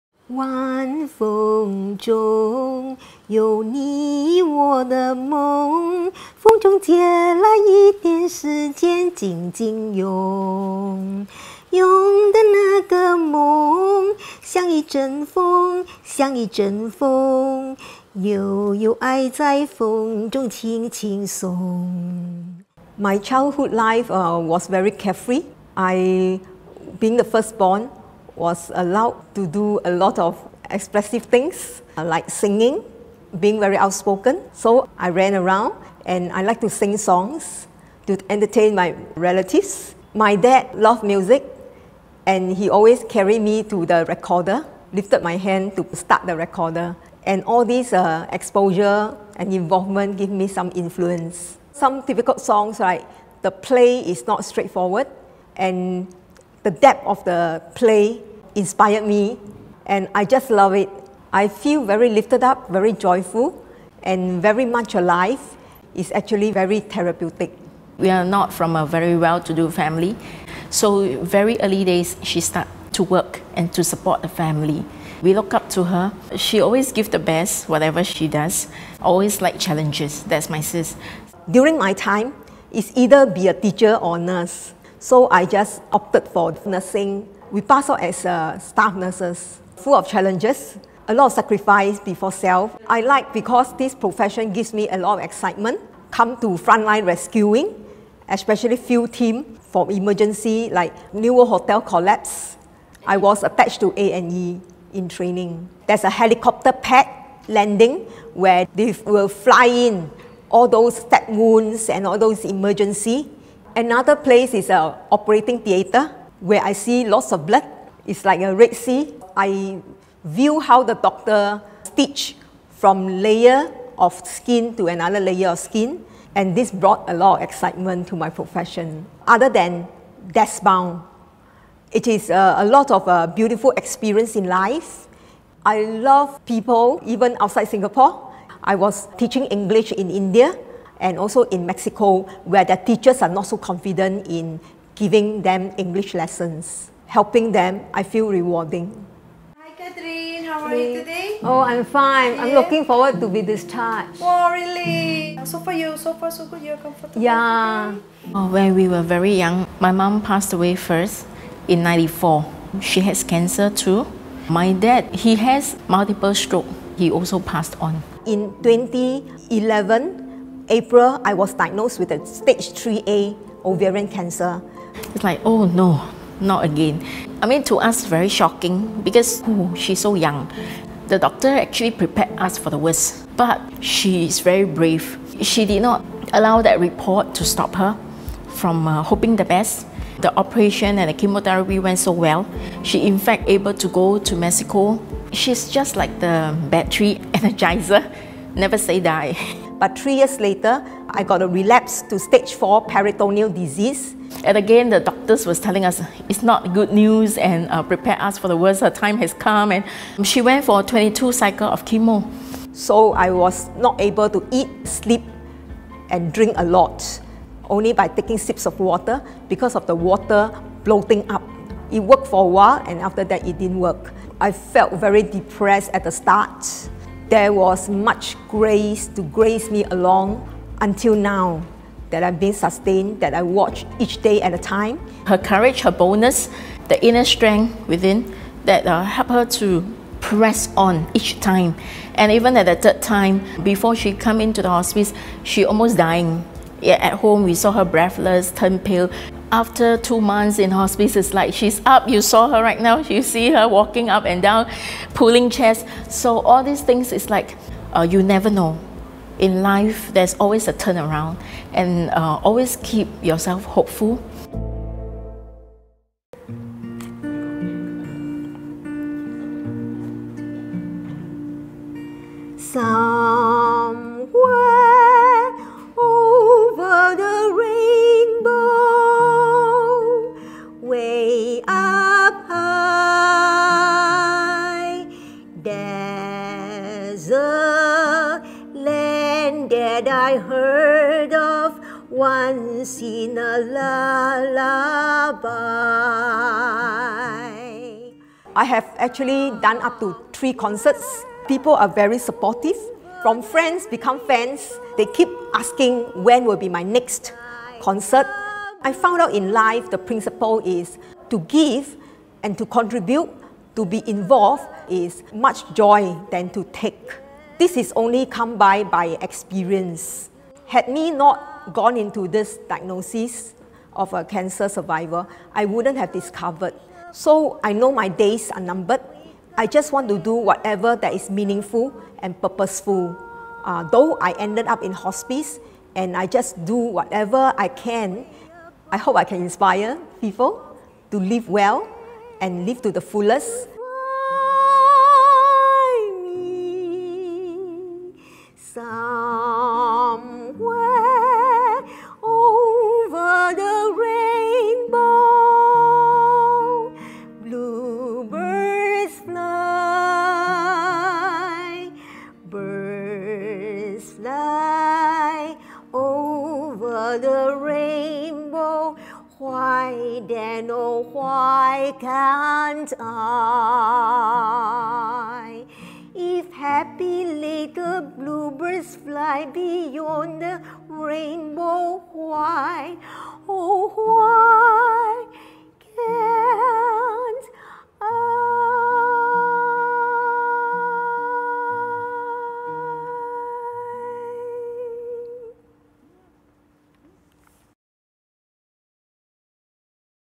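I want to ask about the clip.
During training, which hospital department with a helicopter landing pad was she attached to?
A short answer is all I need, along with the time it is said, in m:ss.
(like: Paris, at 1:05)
A&E, at 1:43.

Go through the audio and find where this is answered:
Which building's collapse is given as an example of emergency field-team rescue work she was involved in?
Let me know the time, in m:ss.
1:41.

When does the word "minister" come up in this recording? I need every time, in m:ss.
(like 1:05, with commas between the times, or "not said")
not said.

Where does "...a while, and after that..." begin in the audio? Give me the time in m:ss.
3:42.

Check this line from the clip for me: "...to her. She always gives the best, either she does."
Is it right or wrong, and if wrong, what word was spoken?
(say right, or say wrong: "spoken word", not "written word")
wrong: "whatever", not "either".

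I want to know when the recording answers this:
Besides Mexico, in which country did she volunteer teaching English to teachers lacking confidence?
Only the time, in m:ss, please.
2:20.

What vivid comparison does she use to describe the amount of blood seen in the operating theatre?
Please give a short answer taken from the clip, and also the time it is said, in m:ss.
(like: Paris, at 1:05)
Red Sea, at 1:58.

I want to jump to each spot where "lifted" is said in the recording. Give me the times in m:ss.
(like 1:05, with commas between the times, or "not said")
0:44, 1:02.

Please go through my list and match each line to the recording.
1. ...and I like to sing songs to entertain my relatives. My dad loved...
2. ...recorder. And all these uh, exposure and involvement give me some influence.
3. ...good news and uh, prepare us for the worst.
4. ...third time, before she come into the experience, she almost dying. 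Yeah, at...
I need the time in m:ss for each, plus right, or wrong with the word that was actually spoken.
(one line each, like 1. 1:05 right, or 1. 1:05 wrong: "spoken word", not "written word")
1. 0:36 right
2. 0:46 right
3. 3:26 right
4. 4:02 wrong: "hospice", not "experience".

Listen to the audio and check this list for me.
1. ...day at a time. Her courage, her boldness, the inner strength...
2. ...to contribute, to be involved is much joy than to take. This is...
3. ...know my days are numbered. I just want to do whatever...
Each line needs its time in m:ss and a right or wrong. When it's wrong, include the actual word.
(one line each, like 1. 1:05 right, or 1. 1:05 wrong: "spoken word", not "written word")
1. 3:54 right
2. 5:12 right
3. 5:27 right.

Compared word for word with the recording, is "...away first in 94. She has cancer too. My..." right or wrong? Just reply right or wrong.
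right.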